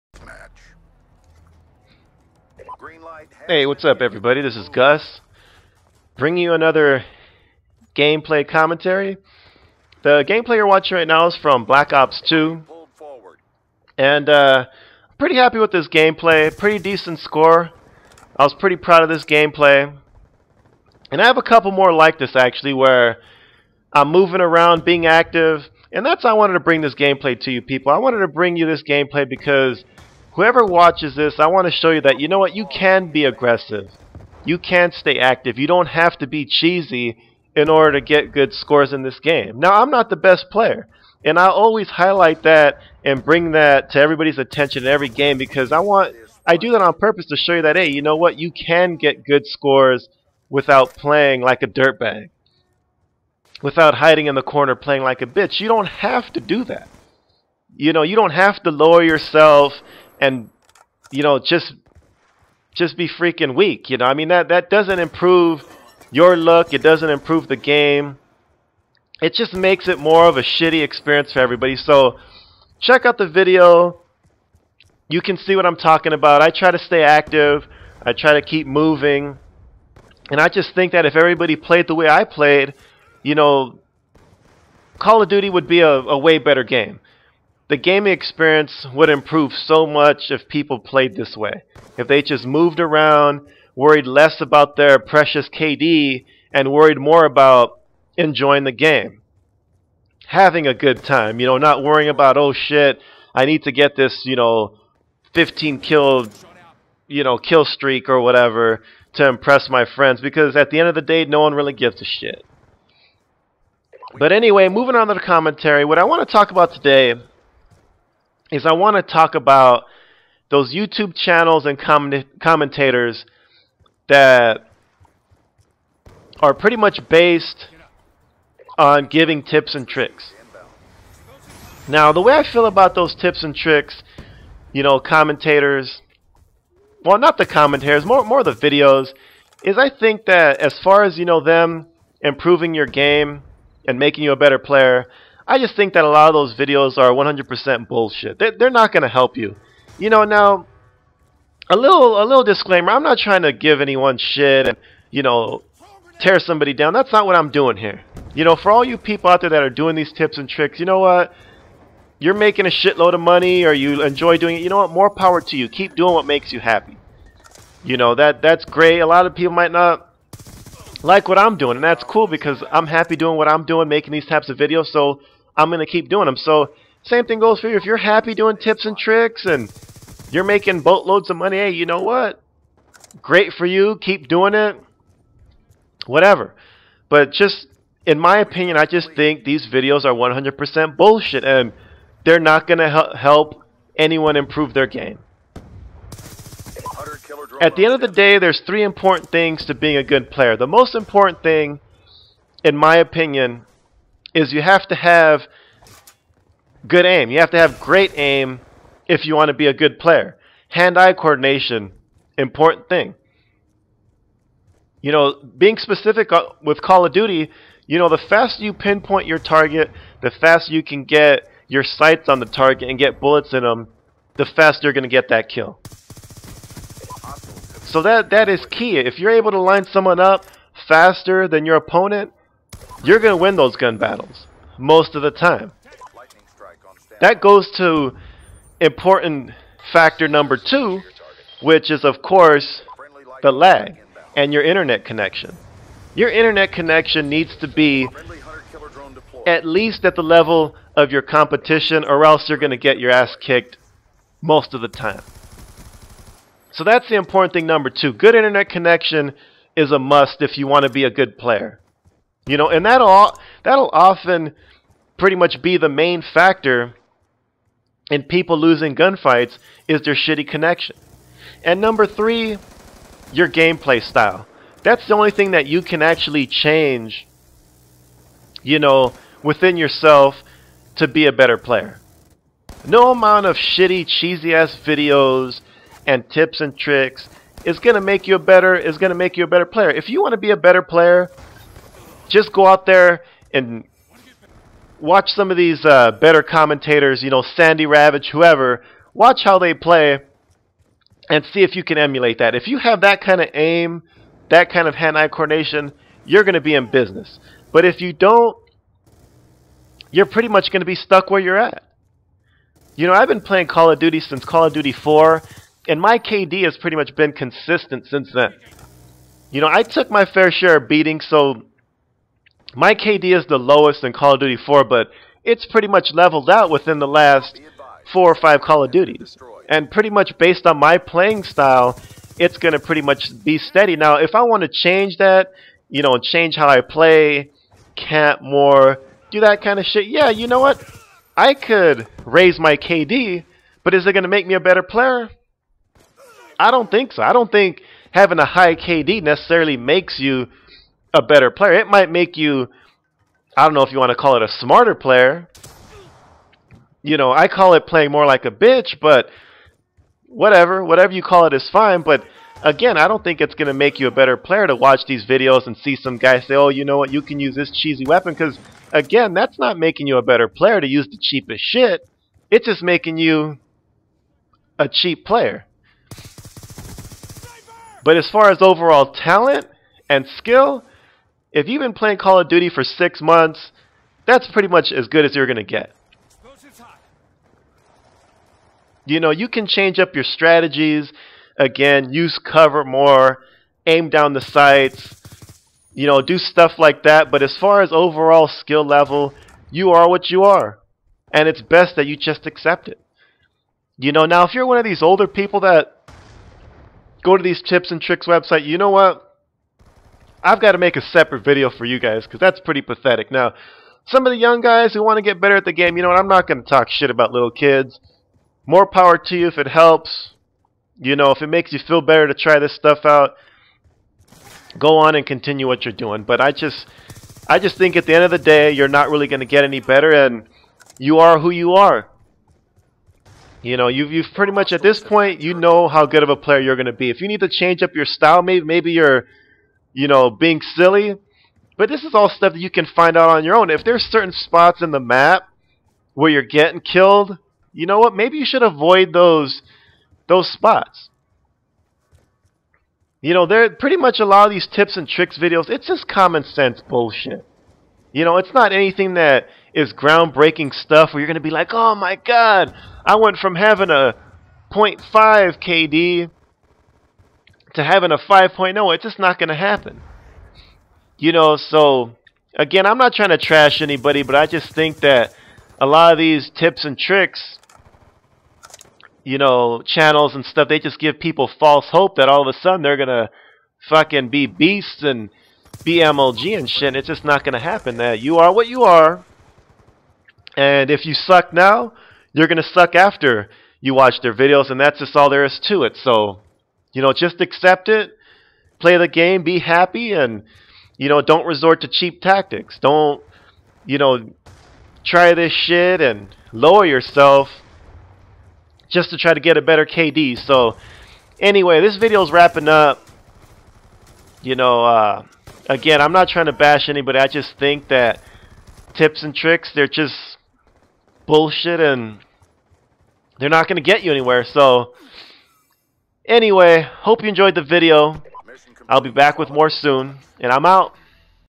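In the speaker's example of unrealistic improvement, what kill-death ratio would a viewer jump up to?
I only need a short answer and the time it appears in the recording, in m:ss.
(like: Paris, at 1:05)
5.0, at 7:48.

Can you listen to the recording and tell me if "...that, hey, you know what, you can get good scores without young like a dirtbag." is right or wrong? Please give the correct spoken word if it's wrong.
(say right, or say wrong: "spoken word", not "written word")
wrong: "playing", not "young".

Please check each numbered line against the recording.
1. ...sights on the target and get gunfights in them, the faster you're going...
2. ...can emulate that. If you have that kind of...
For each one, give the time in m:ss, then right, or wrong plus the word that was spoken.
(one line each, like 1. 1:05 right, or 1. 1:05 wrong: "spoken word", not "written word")
1. 3:41 wrong: "bullets", not "gunfights"
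2. 5:01 right.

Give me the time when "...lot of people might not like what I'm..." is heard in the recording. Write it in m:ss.
2:49.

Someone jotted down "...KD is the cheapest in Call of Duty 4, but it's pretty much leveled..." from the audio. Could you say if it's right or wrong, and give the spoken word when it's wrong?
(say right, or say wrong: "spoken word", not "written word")
wrong: "lowest", not "cheapest".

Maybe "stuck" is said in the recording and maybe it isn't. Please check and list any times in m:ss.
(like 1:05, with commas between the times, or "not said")
5:10.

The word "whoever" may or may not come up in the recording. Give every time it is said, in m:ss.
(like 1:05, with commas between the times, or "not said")
0:30, 4:58.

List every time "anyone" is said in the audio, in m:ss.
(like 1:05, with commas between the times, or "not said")
2:33, 3:13.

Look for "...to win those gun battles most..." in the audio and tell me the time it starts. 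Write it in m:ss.
3:53.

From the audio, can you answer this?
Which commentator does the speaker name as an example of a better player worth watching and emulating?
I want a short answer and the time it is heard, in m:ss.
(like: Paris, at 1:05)
Sandy Ravage, at 4:57.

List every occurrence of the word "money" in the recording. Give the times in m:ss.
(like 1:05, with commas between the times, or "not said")
2:43, 3:01.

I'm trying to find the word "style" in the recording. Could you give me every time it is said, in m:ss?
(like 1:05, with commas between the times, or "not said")
4:34, 5:31, 7:18.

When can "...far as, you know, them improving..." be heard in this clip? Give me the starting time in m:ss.
2:20.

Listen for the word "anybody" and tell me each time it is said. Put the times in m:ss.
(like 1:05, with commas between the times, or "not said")
7:53, 8:36.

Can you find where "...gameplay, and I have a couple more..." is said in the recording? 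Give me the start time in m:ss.
0:19.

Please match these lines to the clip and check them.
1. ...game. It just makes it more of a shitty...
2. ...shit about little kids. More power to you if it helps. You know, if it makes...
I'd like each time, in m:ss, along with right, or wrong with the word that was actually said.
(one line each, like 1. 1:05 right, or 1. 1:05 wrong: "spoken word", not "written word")
1. 1:07 right
2. 6:56 right.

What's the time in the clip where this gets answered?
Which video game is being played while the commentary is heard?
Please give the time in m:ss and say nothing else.
0:11.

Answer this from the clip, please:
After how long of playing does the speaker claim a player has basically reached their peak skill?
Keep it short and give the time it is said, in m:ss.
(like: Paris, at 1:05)
Six months, at 6:22.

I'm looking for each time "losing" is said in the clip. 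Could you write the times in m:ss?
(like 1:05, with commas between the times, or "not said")
4:28.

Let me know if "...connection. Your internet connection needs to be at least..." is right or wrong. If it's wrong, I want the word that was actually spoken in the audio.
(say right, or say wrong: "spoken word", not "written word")
right.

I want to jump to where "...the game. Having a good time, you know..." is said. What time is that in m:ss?
1:38.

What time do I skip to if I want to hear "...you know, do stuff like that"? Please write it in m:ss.
6:35.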